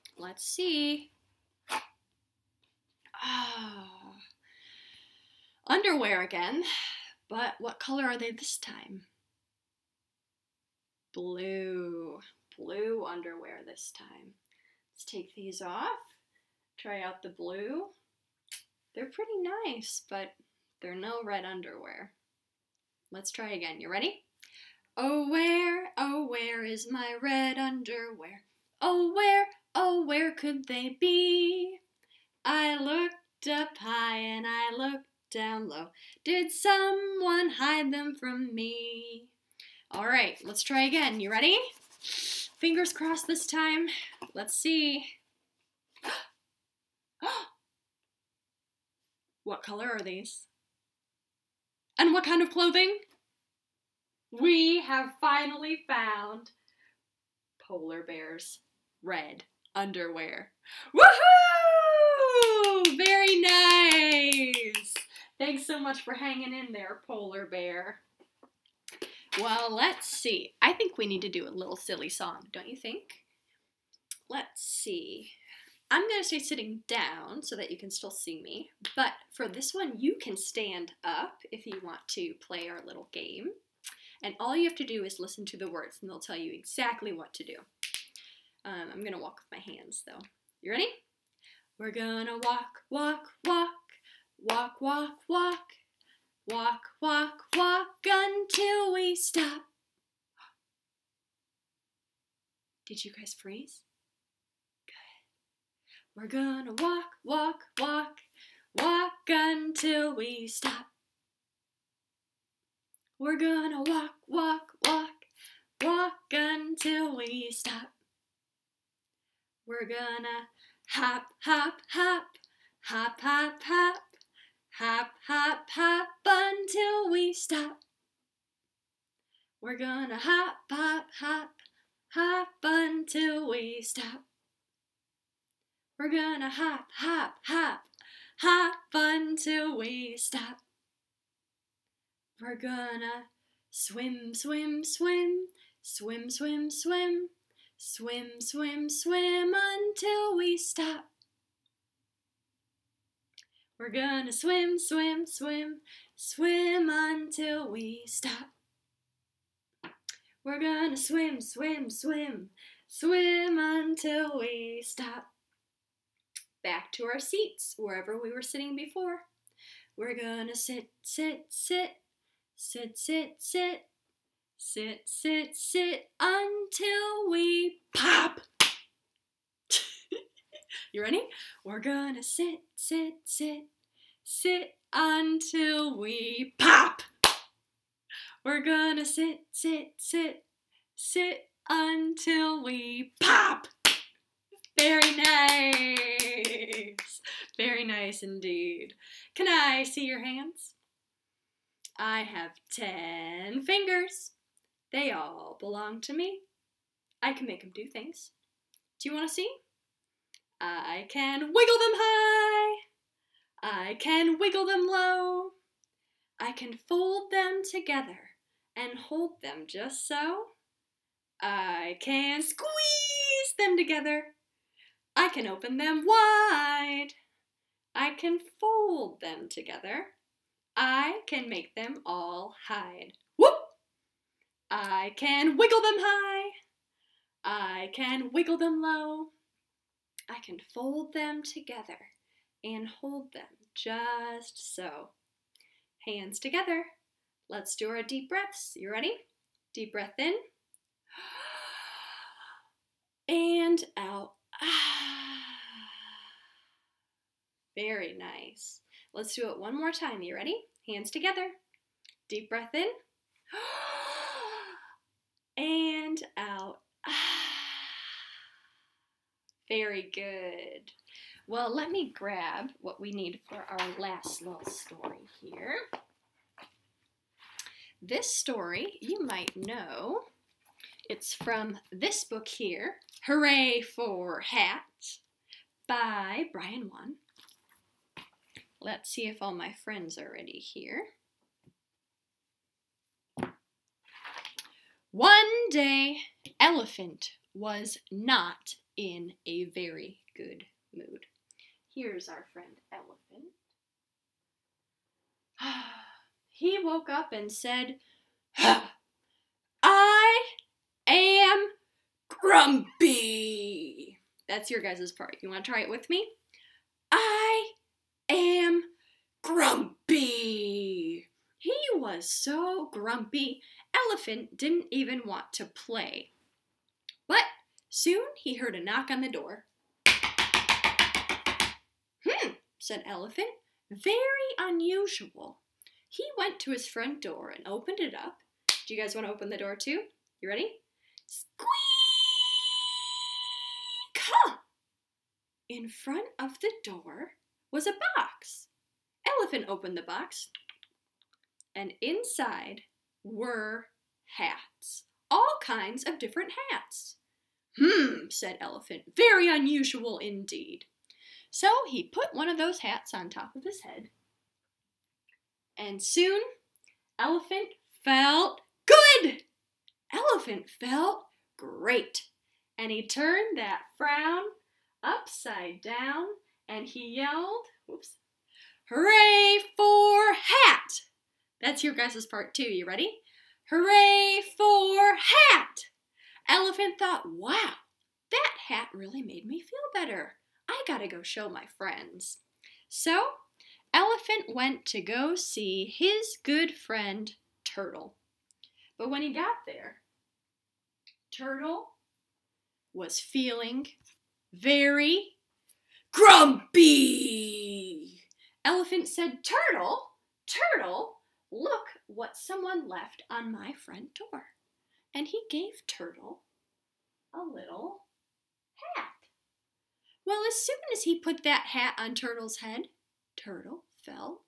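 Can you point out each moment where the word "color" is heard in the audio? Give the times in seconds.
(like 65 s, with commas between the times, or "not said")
7 s, 49 s.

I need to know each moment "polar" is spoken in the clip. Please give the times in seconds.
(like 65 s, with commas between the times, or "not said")
57 s, 67 s.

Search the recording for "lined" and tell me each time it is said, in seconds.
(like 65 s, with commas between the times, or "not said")
not said.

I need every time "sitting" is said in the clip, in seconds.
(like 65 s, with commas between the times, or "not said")
76 s, 168 s.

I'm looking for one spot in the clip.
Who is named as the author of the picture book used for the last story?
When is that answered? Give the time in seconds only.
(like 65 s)
286 s.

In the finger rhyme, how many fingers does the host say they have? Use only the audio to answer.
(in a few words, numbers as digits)
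10.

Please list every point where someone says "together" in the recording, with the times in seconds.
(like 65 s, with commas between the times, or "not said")
217 s, 223 s, 229 s, 241 s, 246 s, 261 s.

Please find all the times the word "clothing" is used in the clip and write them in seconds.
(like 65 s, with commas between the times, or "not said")
52 s.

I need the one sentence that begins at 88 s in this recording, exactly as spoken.
Um, I'm going to walk with my hands, though.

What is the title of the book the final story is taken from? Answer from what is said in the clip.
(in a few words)
Hooray for Hats.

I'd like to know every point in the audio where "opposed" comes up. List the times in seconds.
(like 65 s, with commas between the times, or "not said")
not said.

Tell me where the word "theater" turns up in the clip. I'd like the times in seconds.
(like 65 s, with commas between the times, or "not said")
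not said.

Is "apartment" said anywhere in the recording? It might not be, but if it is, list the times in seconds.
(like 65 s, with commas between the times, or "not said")
not said.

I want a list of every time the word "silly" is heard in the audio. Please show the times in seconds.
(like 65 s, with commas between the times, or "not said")
71 s.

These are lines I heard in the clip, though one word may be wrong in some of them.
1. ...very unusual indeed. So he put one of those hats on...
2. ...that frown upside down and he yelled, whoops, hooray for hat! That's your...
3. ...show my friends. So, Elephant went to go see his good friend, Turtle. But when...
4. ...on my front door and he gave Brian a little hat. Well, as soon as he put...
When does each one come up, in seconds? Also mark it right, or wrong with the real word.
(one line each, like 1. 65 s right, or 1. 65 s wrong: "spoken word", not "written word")
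1. 359 s right
2. 373 s right
3. 391 s right
4. 413 s wrong: "Turtle", not "Brian".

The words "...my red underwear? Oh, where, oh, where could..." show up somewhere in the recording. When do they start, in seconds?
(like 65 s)
26 s.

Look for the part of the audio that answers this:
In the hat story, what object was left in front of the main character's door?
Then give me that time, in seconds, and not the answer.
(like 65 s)
347 s.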